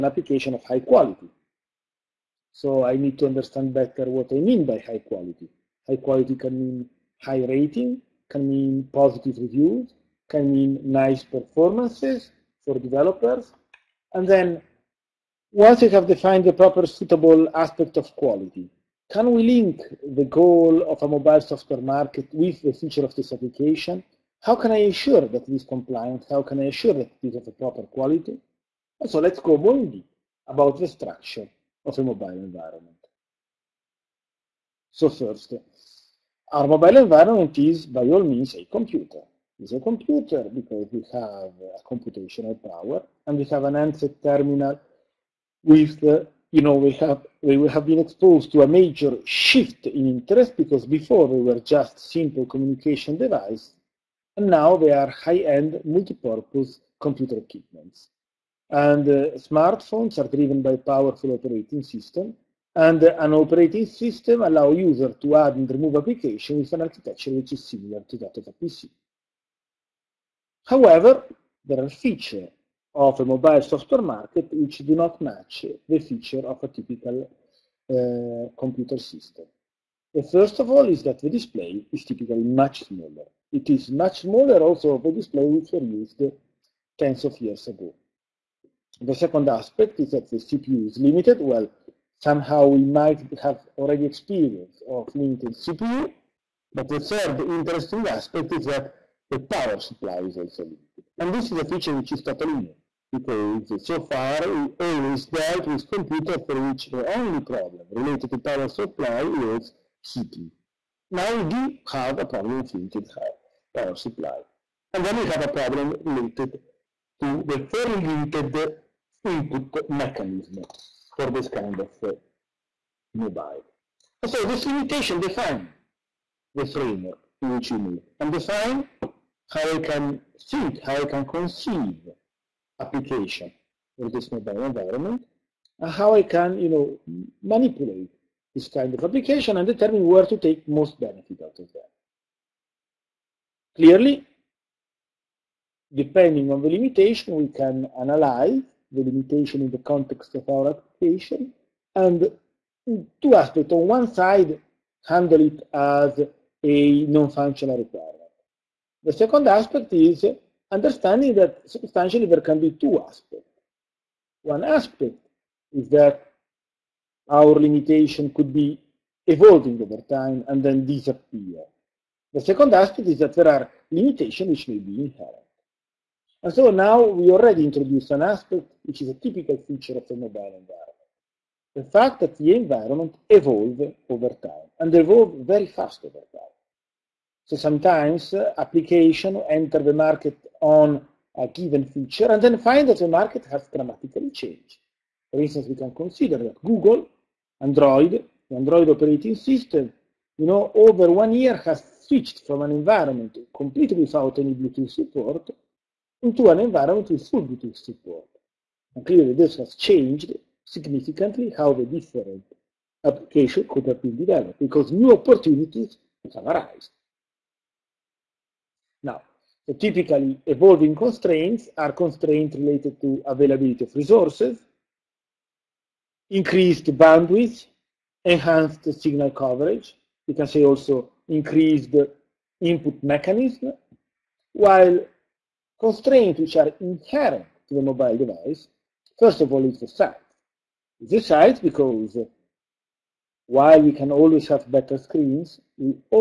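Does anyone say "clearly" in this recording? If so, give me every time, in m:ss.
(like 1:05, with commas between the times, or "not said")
2:23, 3:29.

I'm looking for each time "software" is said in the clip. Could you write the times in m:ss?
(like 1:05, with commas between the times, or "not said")
0:21, 1:13.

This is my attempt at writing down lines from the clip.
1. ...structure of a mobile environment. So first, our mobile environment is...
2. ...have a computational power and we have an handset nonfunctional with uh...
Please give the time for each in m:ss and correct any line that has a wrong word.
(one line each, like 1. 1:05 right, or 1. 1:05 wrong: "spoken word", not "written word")
1. 0:30 right
2. 0:41 wrong: "terminal", not "nonfunctional".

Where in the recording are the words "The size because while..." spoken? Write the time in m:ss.
4:00.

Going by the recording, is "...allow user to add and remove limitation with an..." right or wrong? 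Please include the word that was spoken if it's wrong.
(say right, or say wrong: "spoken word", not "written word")
wrong: "application", not "limitation".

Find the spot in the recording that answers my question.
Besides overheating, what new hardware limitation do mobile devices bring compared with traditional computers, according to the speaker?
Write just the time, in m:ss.
1:39.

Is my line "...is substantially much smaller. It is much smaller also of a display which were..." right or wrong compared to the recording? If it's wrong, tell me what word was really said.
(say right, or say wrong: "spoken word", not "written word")
wrong: "typically", not "substantially".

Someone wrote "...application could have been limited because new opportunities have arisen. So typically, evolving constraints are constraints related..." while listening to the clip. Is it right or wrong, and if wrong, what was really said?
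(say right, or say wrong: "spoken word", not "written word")
wrong: "developed", not "limited".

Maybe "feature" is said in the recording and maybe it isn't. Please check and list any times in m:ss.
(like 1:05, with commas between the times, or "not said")
1:11, 1:15, 1:41, 2:59, 3:11.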